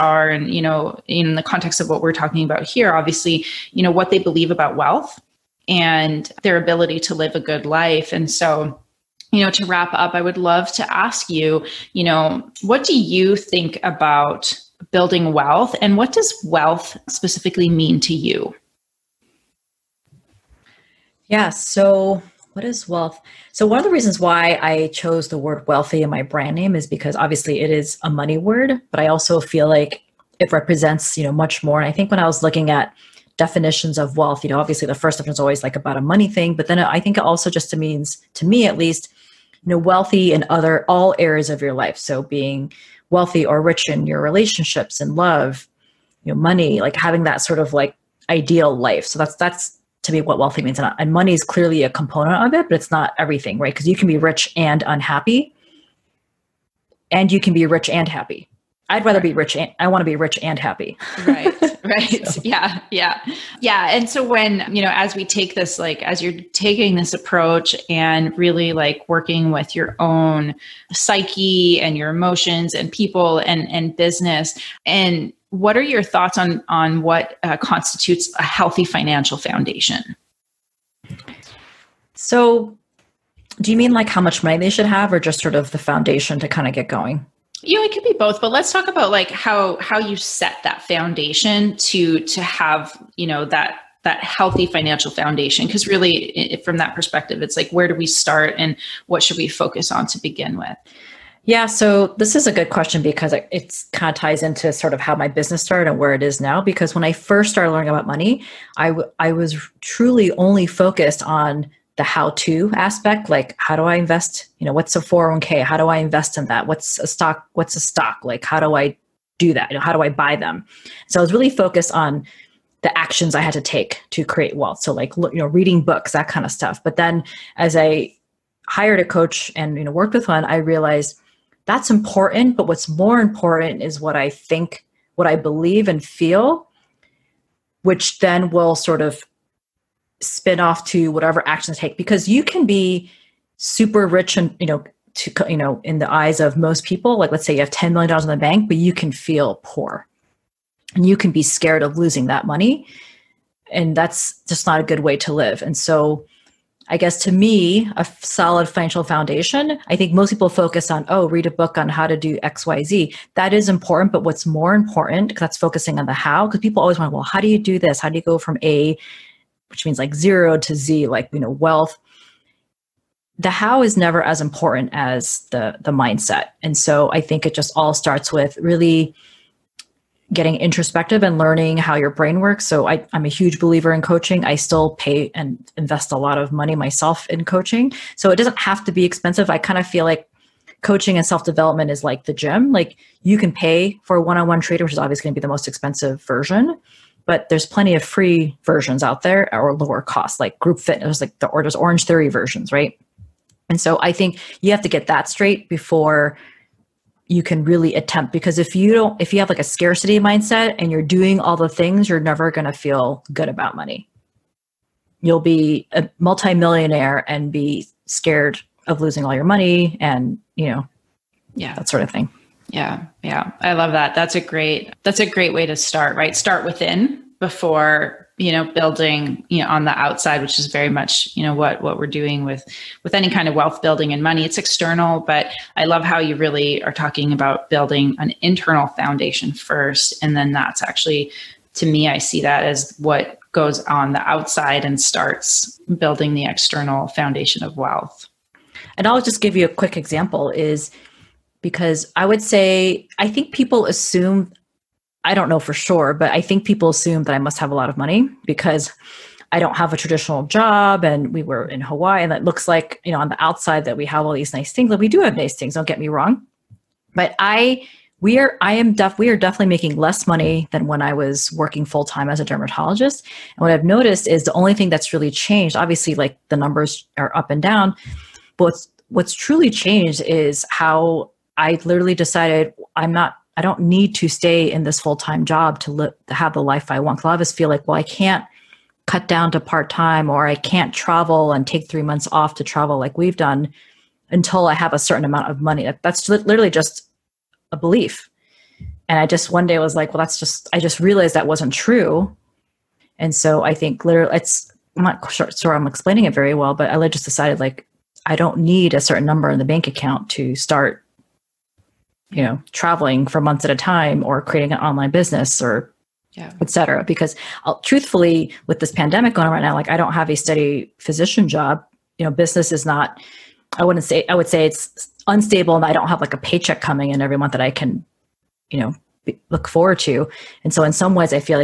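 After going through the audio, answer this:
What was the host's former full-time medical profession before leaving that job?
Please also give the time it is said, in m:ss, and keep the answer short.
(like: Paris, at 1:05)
Dermatologist, at 4:32.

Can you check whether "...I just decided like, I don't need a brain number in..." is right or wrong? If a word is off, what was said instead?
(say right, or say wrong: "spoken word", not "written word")
wrong: "certain", not "brain".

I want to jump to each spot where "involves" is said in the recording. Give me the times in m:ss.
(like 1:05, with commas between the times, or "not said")
not said.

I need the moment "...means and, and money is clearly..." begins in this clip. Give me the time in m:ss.
0:50.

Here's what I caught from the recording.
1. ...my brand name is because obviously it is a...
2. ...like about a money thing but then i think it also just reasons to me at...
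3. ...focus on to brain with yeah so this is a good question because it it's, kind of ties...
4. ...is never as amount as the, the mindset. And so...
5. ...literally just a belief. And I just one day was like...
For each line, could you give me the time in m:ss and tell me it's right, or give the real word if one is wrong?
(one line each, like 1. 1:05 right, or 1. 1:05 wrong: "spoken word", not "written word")
1. 0:26 right
2. 0:35 wrong: "means", not "reasons"
3. 1:39 wrong: "begin", not "brain"
4. 2:53 wrong: "important", not "amount"
5. 4:56 right.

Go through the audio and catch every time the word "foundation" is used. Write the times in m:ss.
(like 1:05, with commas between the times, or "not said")
1:19, 1:25, 1:30, 1:35, 2:39, 3:58, 4:07.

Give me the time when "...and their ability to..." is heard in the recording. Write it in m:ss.
0:05.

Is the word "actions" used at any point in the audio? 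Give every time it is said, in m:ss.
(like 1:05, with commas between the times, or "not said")
2:02, 2:21.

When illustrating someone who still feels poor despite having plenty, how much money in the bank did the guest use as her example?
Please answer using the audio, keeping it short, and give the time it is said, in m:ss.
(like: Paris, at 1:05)
$10 million, at 2:27.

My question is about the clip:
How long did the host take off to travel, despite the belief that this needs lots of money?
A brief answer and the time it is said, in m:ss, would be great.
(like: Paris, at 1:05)
3 months, at 4:51.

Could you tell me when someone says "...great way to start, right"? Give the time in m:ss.
3:45.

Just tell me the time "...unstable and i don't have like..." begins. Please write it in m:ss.
5:25.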